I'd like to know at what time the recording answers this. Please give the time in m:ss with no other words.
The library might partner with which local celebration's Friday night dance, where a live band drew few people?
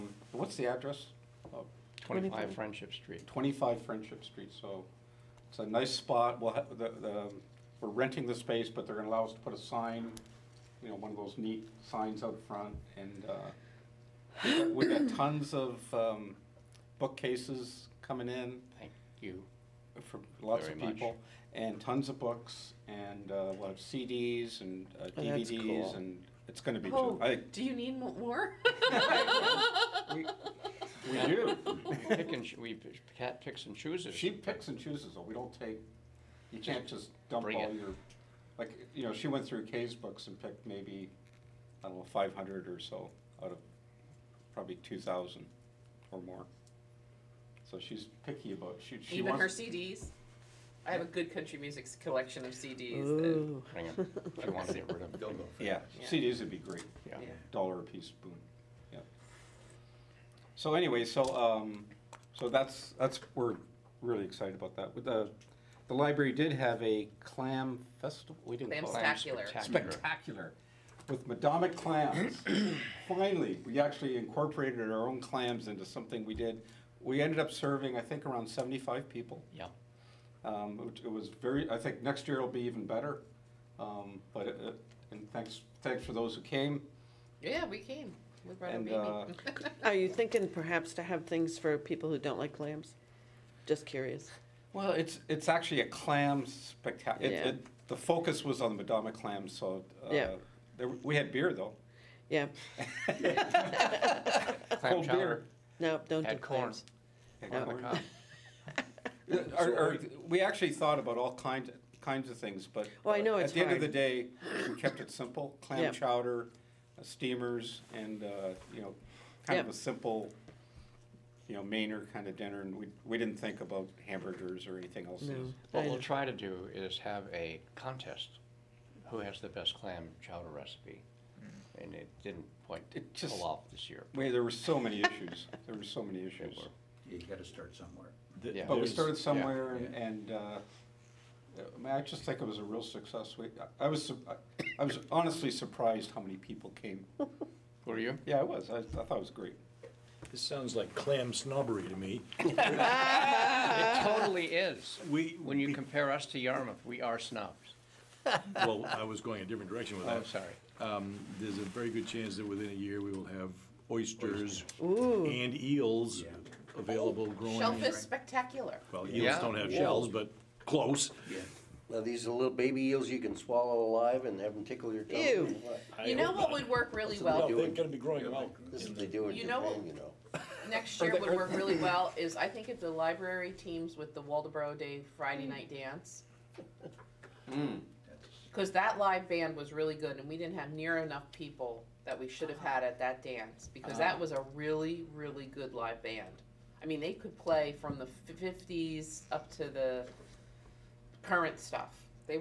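3:04.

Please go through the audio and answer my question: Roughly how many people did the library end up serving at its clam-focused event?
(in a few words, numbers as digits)
75.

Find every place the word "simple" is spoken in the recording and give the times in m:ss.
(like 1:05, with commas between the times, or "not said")
1:55, 1:59.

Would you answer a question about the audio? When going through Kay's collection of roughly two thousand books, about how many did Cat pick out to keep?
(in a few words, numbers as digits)
500.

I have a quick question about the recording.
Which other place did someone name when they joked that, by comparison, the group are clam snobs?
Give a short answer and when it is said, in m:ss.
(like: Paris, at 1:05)
Yarmouth, at 2:36.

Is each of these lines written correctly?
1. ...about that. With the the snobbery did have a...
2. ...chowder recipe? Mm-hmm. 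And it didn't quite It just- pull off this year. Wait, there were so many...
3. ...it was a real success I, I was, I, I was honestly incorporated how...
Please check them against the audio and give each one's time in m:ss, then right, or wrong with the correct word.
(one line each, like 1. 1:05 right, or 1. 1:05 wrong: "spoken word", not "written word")
1. 1:04 wrong: "library", not "snobbery"
2. 2:10 right
3. 2:22 wrong: "surprised", not "incorporated".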